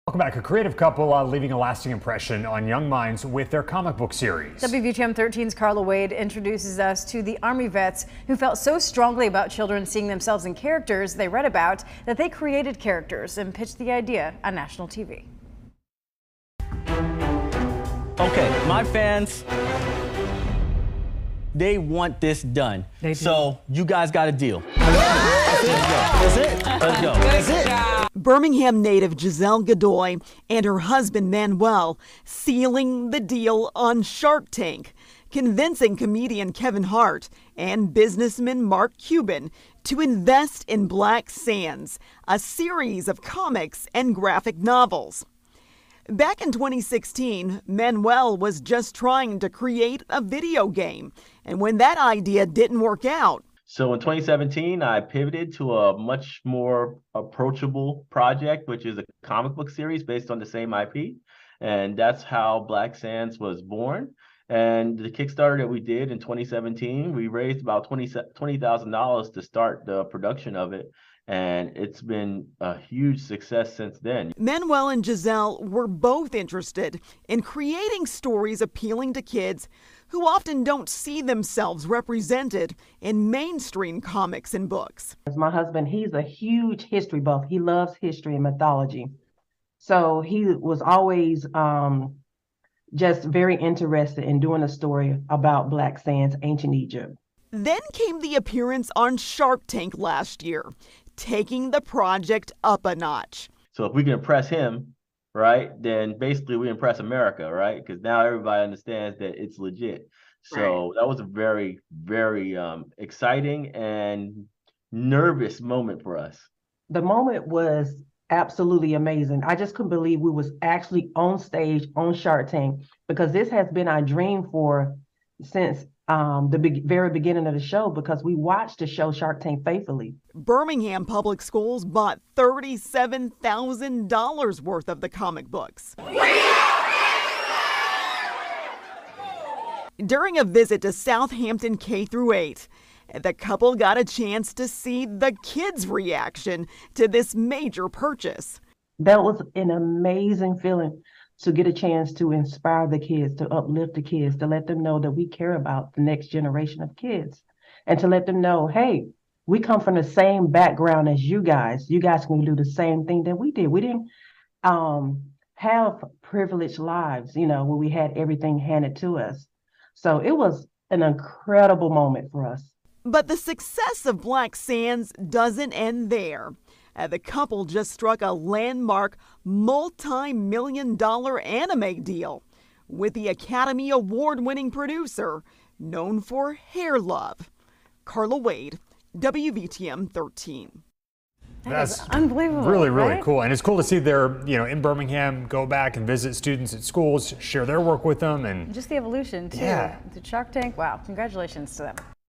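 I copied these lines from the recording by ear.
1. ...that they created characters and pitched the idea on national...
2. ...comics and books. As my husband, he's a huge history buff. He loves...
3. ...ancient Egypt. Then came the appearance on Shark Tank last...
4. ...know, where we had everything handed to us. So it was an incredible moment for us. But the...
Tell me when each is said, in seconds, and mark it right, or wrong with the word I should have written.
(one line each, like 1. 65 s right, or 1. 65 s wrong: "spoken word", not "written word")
1. 12 s right
2. 84 s right
3. 96 s right
4. 167 s right.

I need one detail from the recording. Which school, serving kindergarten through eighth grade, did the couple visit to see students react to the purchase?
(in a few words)
Southampton K-8.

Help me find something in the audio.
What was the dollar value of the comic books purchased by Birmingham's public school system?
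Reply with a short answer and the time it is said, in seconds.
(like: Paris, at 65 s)
$37,000, at 132 s.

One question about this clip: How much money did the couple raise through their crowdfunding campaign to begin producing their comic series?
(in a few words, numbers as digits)
$20,000.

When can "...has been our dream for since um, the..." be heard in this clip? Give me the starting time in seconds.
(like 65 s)
123 s.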